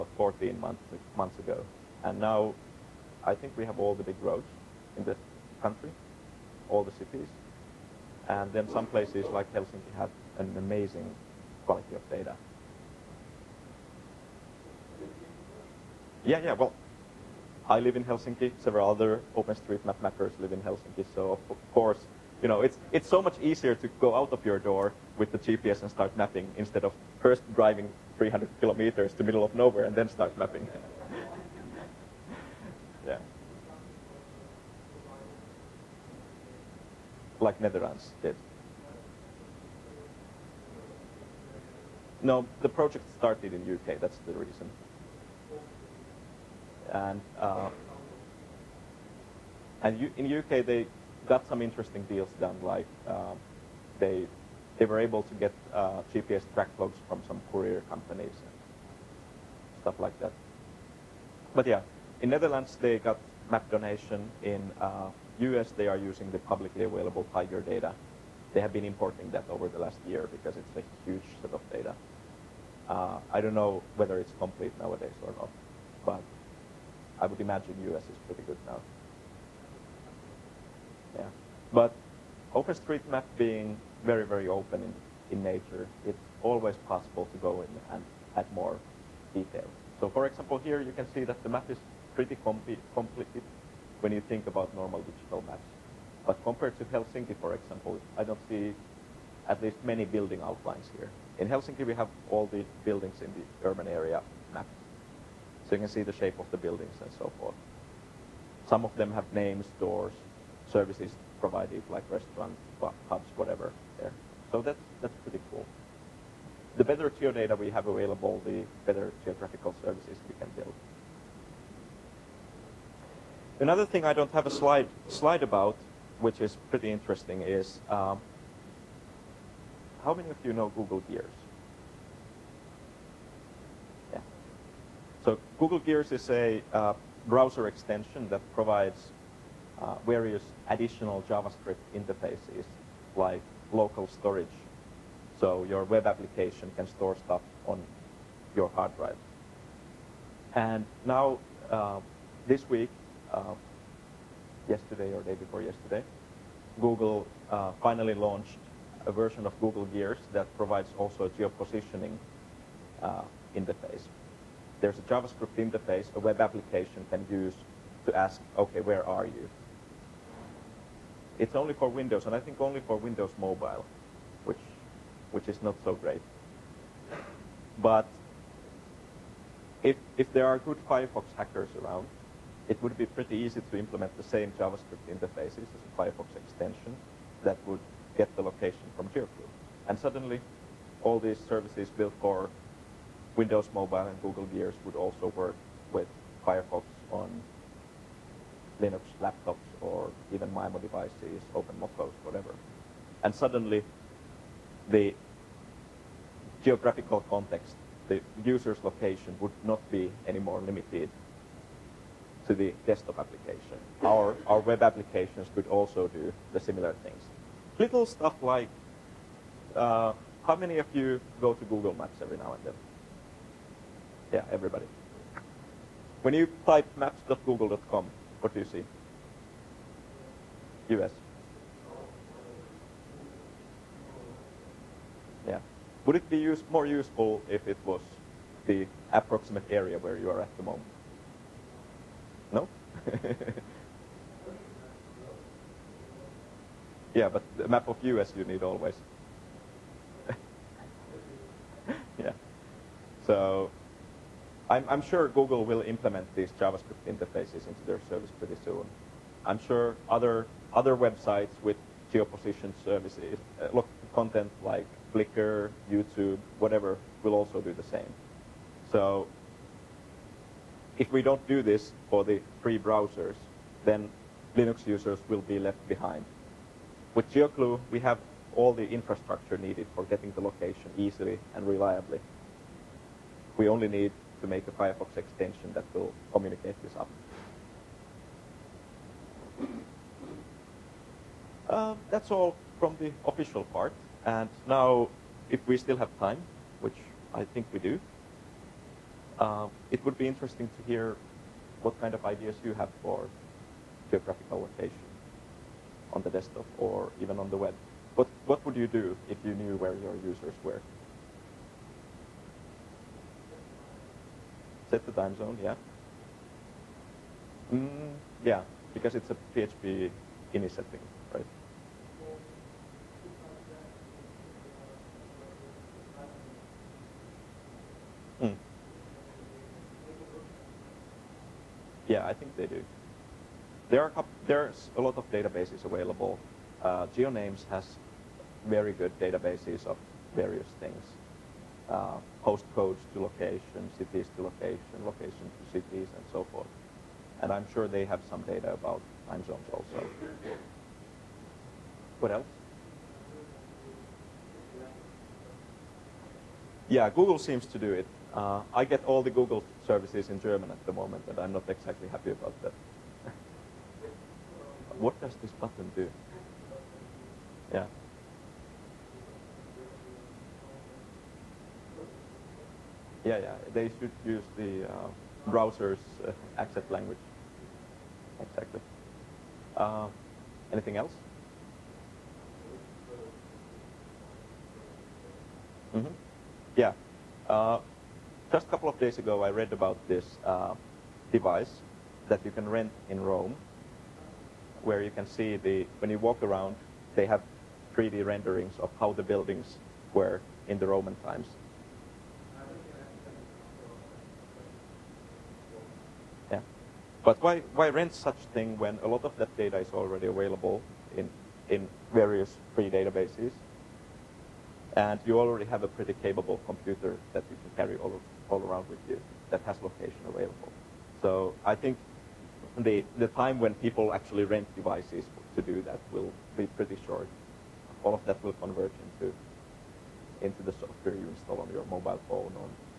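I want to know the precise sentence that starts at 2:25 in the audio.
So your web application can store stuff on your hard drive.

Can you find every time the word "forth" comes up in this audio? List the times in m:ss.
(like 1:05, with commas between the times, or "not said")
1:47, 5:46.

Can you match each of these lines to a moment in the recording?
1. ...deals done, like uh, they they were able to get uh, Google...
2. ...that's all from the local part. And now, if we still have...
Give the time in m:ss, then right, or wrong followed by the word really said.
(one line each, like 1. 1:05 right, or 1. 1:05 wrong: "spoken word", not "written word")
1. 0:52 wrong: "GPS", not "Google"
2. 4:52 wrong: "official", not "local".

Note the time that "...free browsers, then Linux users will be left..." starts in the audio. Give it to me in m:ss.
4:32.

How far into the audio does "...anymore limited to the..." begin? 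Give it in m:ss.
3:30.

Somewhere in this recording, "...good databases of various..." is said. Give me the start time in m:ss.
5:38.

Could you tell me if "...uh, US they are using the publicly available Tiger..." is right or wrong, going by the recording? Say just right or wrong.
right.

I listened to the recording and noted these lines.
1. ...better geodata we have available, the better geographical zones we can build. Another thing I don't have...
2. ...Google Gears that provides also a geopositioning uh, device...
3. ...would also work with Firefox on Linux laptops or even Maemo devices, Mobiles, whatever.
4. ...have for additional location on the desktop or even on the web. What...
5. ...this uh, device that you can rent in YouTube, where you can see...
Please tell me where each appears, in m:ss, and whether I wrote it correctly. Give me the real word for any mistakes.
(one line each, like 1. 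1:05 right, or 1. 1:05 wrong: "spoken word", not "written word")
1. 1:56 wrong: "services", not "zones"
2. 2:39 wrong: "interface", not "device"
3. 3:14 right
4. 5:02 wrong: "geographical", not "additional"
5. 6:30 wrong: "Rome", not "YouTube".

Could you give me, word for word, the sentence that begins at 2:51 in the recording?
It's only for Windows, and I think only for Windows Mobile, which, which is not so great.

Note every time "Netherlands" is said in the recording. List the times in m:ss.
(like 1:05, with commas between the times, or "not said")
0:37, 1:02.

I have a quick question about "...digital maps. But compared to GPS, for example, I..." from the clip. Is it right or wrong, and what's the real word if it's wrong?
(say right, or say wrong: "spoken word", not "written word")
wrong: "Helsinki", not "GPS".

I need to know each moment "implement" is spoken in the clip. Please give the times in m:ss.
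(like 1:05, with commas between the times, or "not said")
3:03, 4:15.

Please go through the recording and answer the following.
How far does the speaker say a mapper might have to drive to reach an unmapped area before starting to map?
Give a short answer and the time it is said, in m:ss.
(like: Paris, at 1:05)
300 kilometers, at 0:28.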